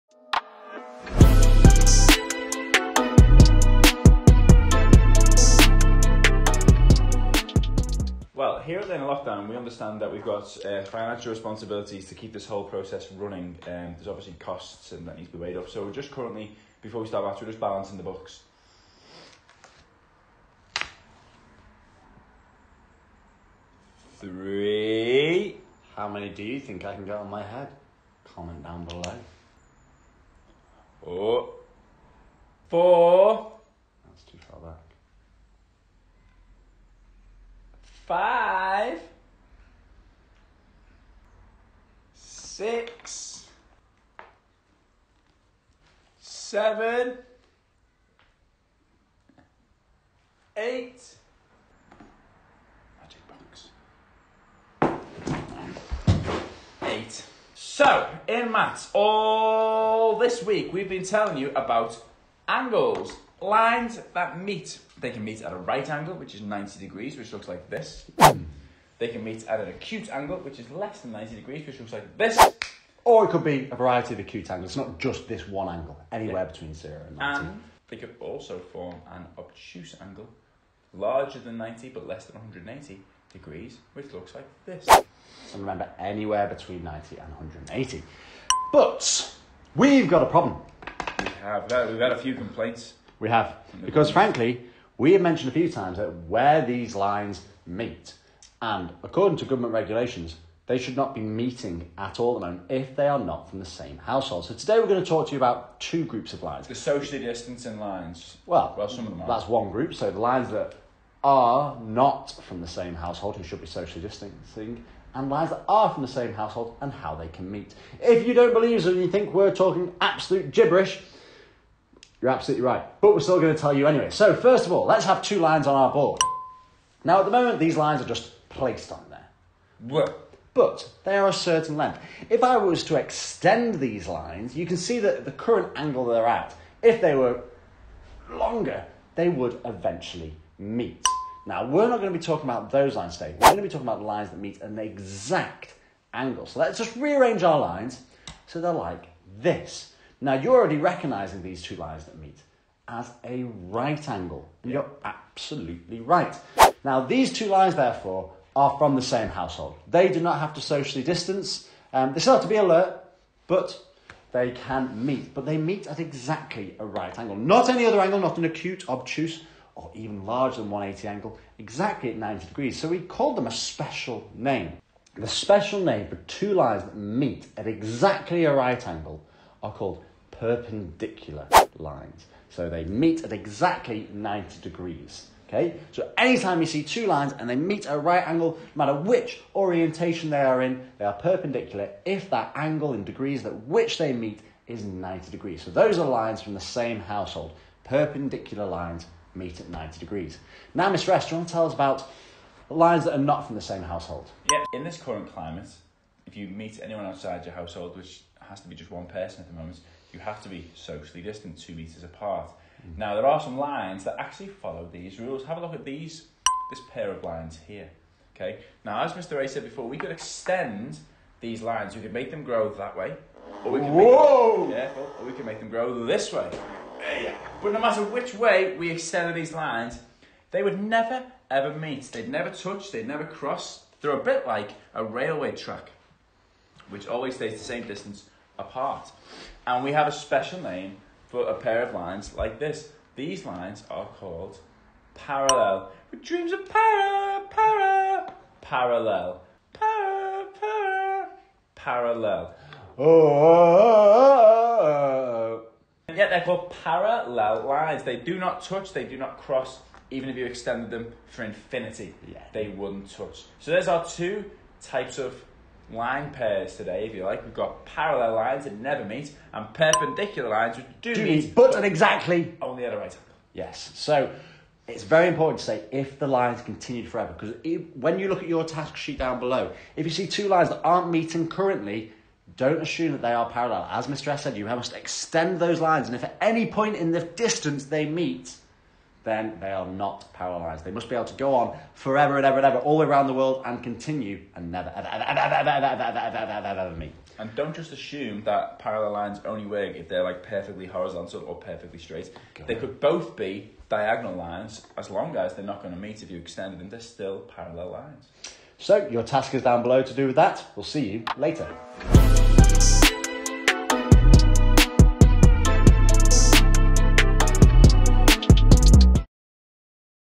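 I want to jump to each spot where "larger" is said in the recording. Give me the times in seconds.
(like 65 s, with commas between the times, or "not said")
80 s, 170 s.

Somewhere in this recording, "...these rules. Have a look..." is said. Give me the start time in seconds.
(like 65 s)
214 s.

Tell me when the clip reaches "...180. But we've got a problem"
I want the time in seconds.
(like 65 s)
87 s.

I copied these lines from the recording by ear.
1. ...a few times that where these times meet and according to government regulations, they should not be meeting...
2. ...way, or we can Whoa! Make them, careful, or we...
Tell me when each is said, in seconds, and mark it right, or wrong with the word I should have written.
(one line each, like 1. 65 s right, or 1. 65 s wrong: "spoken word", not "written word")
1. 95 s wrong: "lines", not "times"
2. 222 s right.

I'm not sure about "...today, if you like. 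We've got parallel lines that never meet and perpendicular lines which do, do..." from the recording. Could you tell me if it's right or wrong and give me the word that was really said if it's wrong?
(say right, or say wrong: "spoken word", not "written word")
right.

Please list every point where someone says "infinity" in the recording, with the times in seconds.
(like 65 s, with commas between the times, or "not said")
261 s.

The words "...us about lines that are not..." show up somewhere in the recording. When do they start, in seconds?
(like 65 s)
201 s.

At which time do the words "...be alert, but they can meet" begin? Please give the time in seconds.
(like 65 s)
162 s.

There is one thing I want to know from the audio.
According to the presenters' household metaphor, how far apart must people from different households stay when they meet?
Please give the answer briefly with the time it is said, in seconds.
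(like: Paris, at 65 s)
2 metres, at 211 s.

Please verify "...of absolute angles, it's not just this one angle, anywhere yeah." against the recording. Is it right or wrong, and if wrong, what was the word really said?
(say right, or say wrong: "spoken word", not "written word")
wrong: "acute", not "absolute".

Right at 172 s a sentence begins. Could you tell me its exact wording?
So we called them a special name.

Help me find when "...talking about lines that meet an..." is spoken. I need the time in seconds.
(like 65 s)
143 s.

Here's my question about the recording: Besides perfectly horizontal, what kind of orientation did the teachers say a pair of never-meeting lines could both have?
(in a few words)
diagonal.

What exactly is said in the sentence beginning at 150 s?
Now, you're already recognizing these two lines that meet as a right angle.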